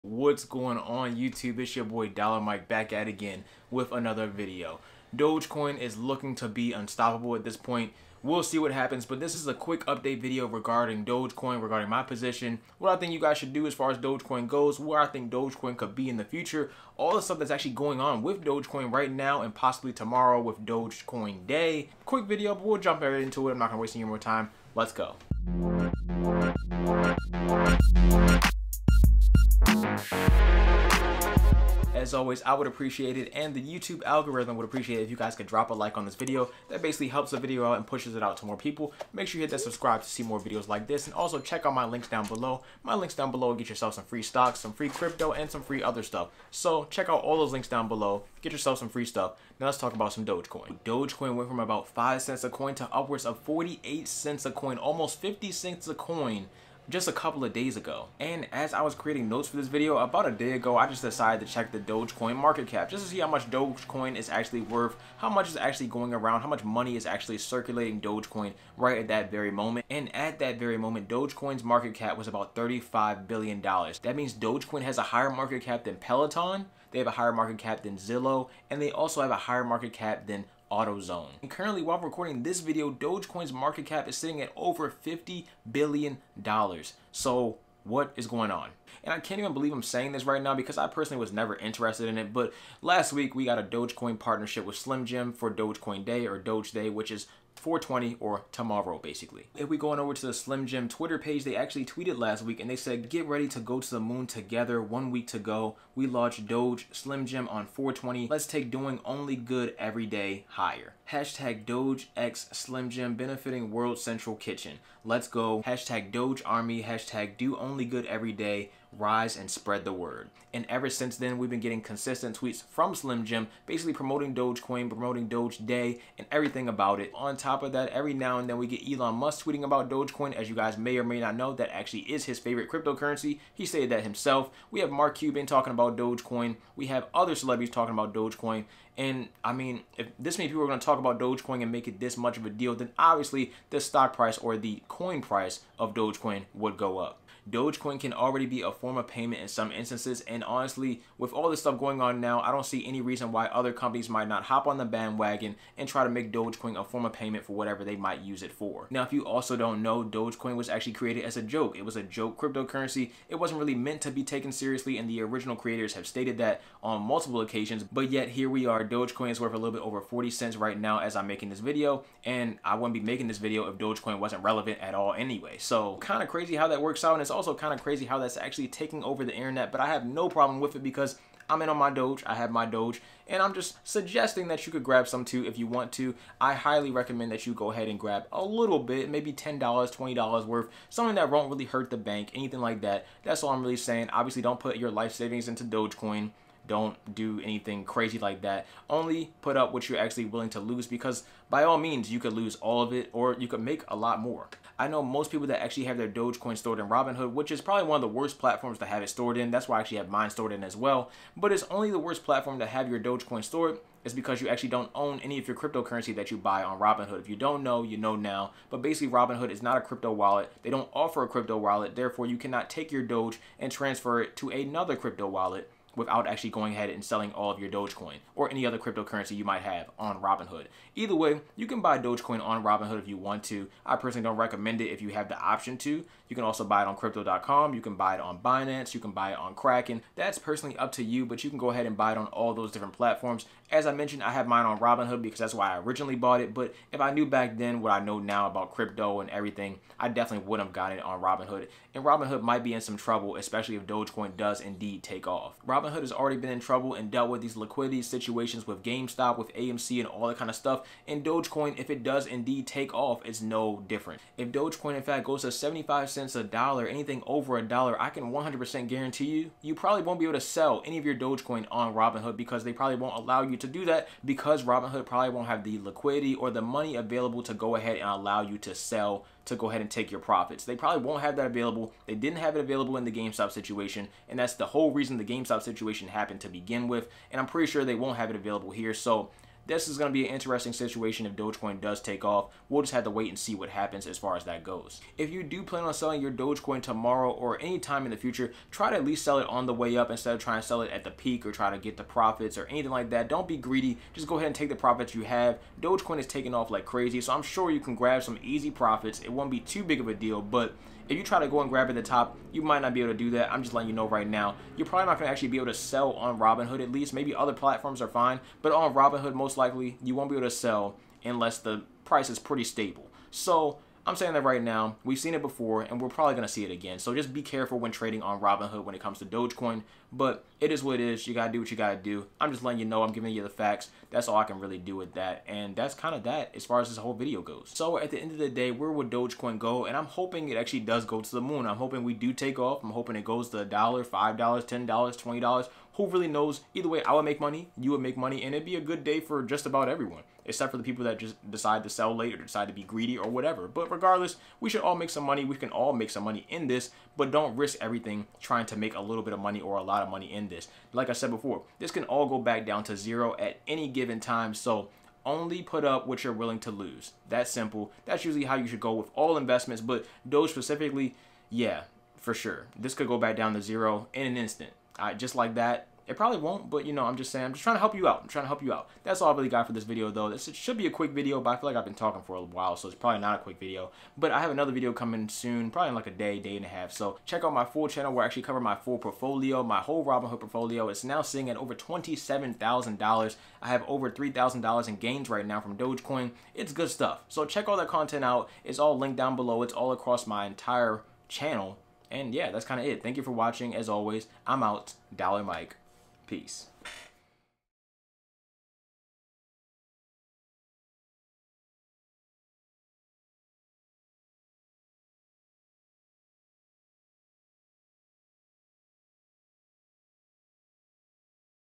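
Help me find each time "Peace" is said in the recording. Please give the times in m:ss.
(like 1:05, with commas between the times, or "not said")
6:46.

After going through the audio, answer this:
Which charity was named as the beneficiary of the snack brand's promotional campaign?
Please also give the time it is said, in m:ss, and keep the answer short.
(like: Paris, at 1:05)
World Central Kitchen, at 1:53.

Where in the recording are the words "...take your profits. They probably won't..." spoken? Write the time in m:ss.
4:39.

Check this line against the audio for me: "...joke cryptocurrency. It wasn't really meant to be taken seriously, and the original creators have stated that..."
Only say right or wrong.
right.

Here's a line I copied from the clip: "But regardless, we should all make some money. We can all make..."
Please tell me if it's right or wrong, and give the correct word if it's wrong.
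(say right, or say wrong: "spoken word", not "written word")
right.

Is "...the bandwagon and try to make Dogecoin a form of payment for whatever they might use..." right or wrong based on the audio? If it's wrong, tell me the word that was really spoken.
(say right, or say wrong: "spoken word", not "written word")
right.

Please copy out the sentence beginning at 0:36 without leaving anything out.
That basically helps the video out and pushes it out to more people.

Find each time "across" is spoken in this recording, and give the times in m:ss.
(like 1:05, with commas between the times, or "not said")
6:39.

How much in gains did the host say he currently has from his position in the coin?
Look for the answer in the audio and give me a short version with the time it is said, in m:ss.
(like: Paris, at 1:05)
over $3,000, at 6:33.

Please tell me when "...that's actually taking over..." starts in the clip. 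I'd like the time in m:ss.
2:58.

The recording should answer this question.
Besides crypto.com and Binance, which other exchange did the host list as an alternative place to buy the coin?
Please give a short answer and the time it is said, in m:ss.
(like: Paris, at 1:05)
Kraken, at 3:59.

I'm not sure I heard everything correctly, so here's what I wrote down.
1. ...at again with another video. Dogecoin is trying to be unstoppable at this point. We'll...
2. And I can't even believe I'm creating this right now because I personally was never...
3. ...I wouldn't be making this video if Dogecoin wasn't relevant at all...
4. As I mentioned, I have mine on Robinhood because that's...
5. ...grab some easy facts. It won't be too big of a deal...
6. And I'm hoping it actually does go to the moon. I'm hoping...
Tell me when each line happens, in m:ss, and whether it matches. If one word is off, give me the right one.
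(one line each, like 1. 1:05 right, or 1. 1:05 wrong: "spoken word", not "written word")
1. 0:02 wrong: "looking", not "trying"
2. 1:29 wrong: "saying", not "creating"
3. 2:52 right
4. 4:03 right
5. 5:07 wrong: "profits", not "facts"
6. 5:39 right.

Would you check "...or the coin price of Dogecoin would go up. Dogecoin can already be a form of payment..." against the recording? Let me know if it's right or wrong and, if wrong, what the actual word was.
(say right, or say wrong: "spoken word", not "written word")
right.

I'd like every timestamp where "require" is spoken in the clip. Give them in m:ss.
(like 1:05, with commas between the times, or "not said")
not said.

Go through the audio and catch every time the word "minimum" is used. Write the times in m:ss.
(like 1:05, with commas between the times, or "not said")
not said.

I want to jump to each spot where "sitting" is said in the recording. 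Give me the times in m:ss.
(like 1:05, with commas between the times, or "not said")
1:24, 6:31.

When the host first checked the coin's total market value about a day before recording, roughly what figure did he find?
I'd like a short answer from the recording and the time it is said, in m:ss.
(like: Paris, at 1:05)
$35 billion, at 1:12.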